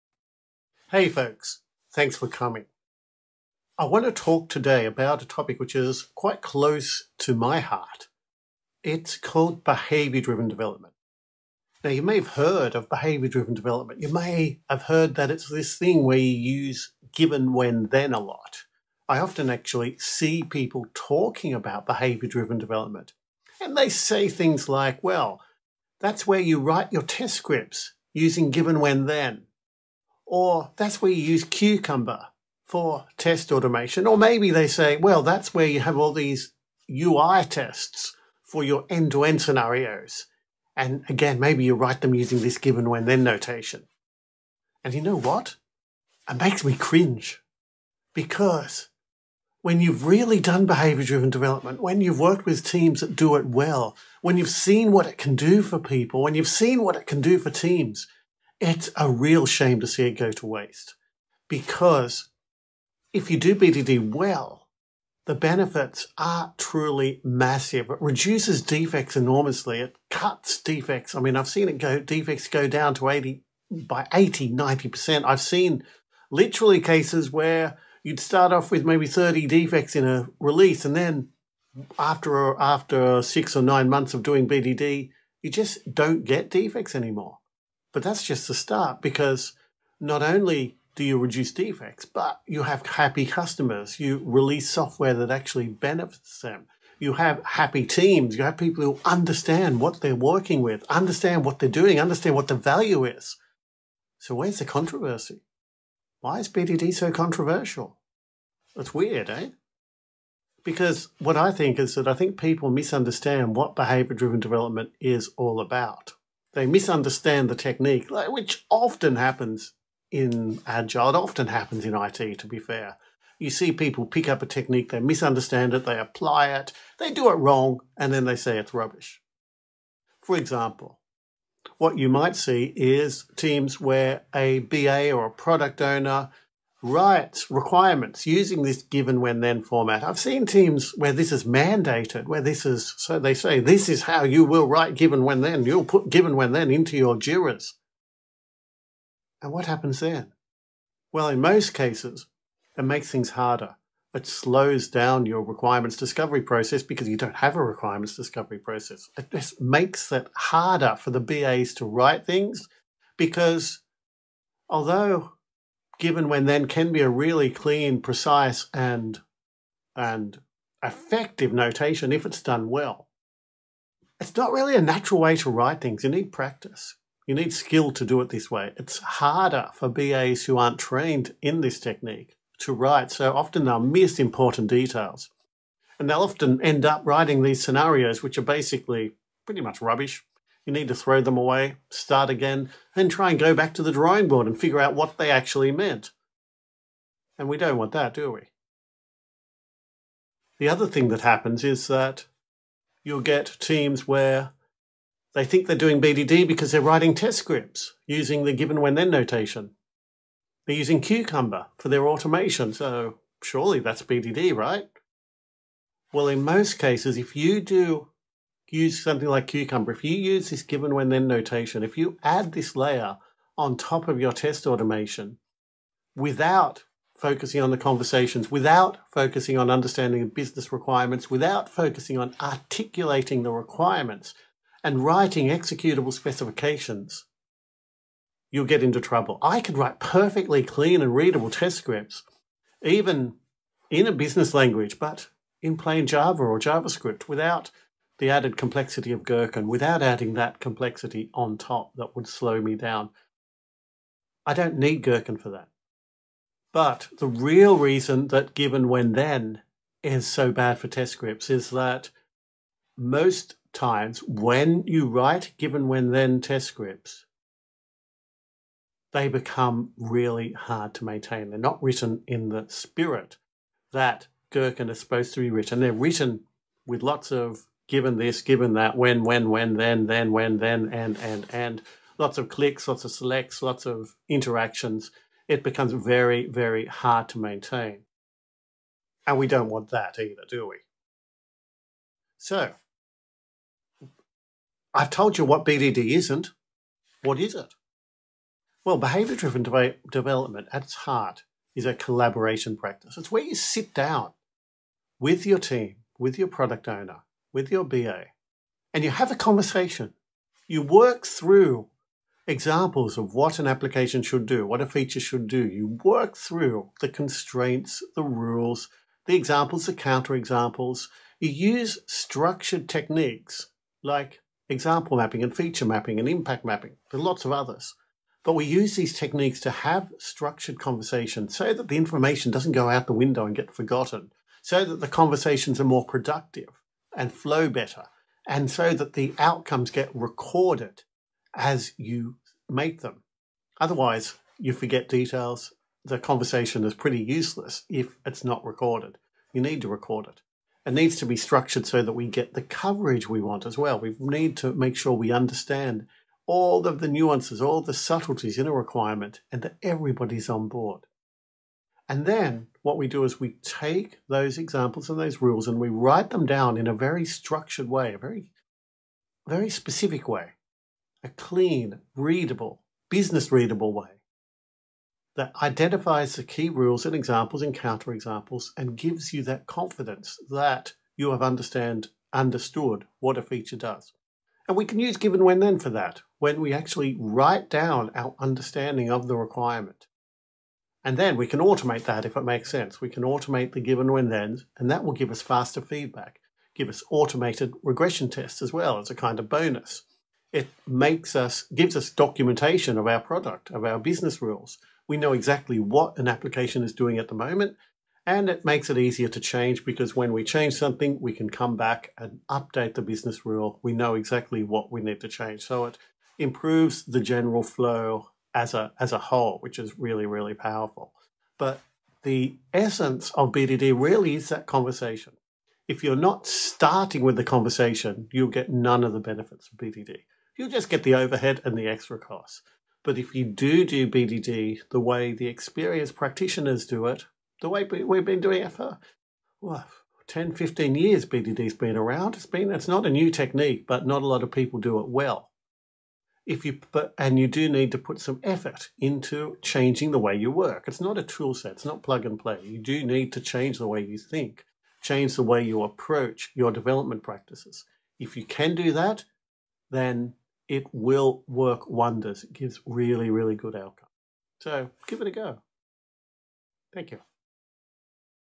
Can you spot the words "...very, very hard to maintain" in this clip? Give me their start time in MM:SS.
04:45.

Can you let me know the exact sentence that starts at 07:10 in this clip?
You'll just get the overhead and the extra costs.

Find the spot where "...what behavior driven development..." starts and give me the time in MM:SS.
01:53.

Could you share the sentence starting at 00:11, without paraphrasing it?
Now, you may have heard of behavior driven development.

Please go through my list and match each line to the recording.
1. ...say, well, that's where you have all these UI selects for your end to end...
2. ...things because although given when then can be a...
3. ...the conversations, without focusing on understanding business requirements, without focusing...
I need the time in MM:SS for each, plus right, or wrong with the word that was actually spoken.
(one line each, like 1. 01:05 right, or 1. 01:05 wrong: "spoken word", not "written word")
1. 00:34 wrong: "tests", not "selects"
2. 02:42 right
3. 03:47 right.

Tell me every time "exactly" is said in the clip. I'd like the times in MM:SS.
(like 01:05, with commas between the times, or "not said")
06:45, 06:54.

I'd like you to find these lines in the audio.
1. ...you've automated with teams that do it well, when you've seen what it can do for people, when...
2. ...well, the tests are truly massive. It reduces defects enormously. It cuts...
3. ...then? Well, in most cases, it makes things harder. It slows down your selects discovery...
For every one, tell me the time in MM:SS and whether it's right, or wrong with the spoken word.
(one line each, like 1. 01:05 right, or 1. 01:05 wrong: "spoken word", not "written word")
1. 00:51 wrong: "worked", not "automated"
2. 01:04 wrong: "benefits", not "tests"
3. 02:29 wrong: "requirements", not "selects".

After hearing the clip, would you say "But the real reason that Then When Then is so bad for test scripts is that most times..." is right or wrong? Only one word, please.
wrong.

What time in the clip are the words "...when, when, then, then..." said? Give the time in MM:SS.
04:39.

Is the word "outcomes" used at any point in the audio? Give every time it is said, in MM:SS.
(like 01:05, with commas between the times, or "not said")
05:39, 07:43.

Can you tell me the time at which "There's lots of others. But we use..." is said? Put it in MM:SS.
05:27.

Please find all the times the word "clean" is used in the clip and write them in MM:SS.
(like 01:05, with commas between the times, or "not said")
02:47, 04:00, 06:11.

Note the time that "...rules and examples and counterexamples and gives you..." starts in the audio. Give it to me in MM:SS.
06:16.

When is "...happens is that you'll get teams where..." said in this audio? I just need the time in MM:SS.
03:21.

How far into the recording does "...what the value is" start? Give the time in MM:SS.
01:42.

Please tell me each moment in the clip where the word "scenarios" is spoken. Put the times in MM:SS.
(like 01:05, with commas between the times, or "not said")
00:39, 03:07.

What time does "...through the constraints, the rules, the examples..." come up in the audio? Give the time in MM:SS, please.
05:16.